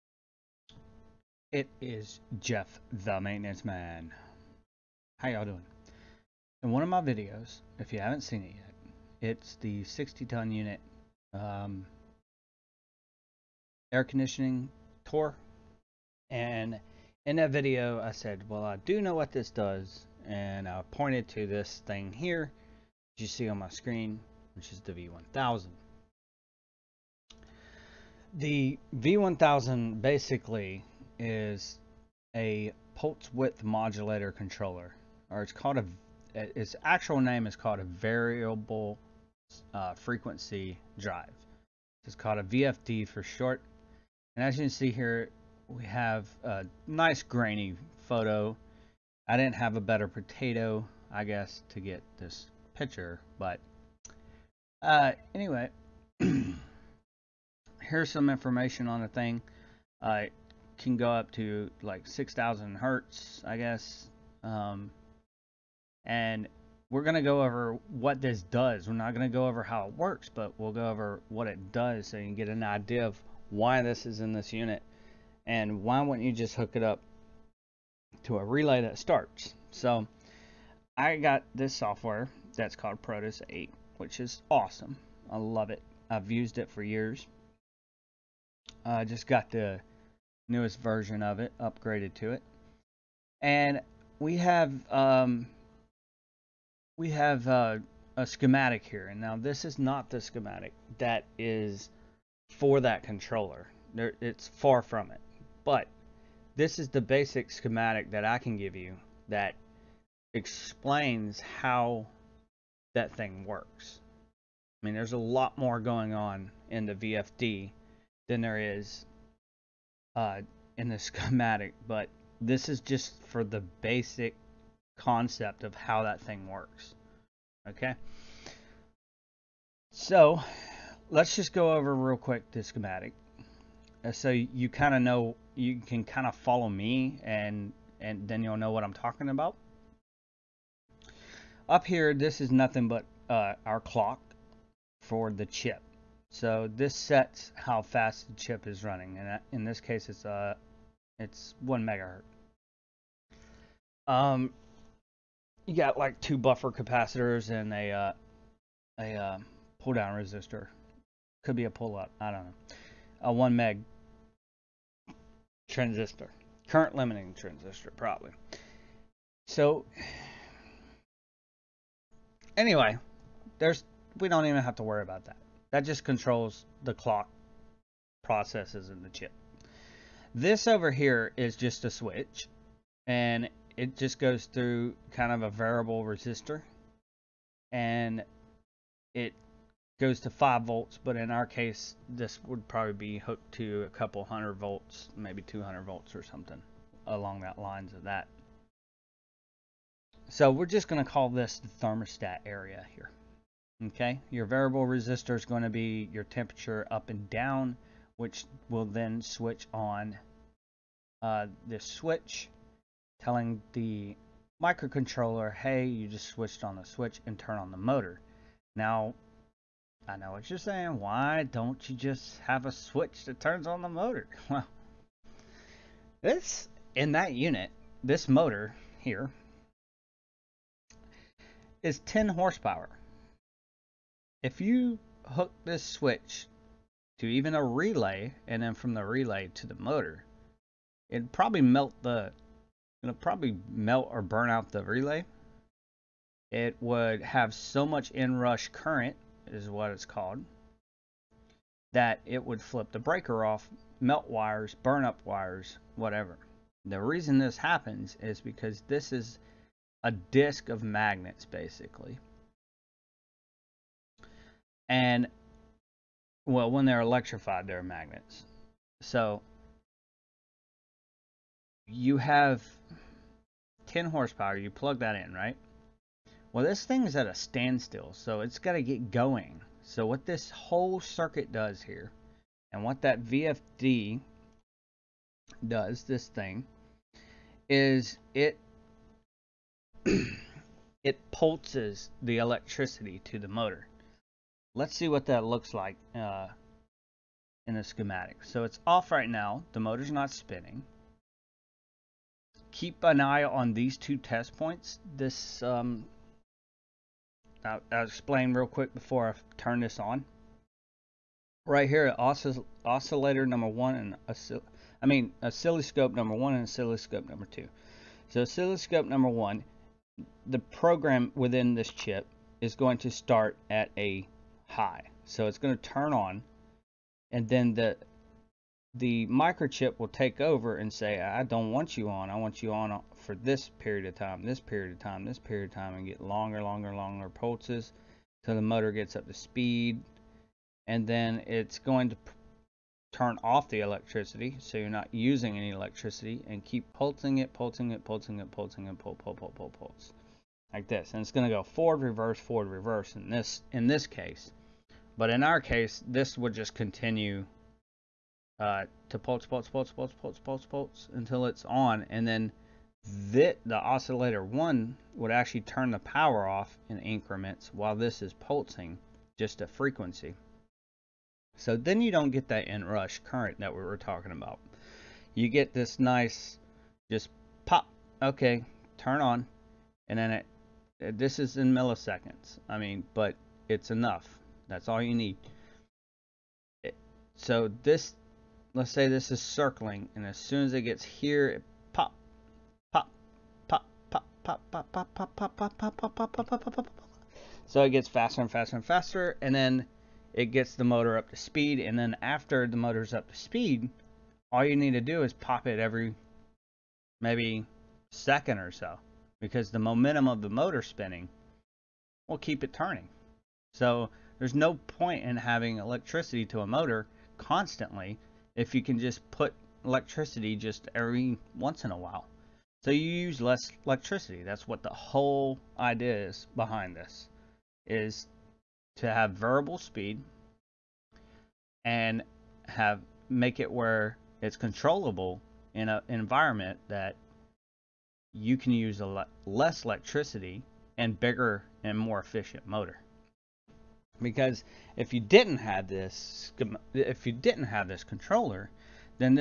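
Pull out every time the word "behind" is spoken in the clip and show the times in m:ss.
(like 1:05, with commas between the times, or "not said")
7:06.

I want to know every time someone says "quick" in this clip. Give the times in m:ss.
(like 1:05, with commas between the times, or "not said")
2:12, 5:08.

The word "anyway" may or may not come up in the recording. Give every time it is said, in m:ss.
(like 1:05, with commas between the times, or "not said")
0:55, 2:52.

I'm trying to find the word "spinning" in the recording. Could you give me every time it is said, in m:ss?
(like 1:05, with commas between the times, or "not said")
5:00, 6:50.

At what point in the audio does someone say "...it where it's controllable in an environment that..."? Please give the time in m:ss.
7:13.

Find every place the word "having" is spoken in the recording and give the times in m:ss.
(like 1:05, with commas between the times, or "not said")
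6:55.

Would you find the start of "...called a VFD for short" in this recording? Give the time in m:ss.
0:42.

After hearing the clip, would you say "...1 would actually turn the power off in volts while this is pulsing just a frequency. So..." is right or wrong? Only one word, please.
wrong.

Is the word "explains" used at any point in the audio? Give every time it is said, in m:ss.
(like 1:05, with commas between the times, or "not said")
1:50, 5:08.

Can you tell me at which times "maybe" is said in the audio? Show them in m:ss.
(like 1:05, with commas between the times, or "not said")
3:15, 6:47.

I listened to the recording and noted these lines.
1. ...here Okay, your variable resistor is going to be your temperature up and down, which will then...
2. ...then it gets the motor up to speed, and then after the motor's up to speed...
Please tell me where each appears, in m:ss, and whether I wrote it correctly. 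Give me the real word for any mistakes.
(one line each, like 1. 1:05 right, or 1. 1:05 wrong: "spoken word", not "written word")
1. 3:22 right
2. 6:39 right.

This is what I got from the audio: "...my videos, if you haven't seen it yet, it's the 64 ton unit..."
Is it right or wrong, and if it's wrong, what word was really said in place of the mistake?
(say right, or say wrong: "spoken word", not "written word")
wrong: "60", not "64".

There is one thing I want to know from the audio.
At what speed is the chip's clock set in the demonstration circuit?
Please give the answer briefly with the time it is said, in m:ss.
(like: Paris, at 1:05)
1 megahertz, at 2:31.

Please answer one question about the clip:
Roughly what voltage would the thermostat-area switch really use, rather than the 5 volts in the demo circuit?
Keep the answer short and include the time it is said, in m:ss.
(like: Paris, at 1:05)
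200 volts, at 3:15.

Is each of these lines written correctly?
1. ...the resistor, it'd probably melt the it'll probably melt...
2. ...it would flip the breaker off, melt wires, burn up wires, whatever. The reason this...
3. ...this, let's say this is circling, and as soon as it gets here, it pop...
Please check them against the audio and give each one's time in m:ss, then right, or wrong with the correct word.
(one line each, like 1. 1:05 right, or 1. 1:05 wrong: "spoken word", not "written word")
1. 3:59 wrong: "motor", not "resistor"
2. 4:12 right
3. 6:27 right.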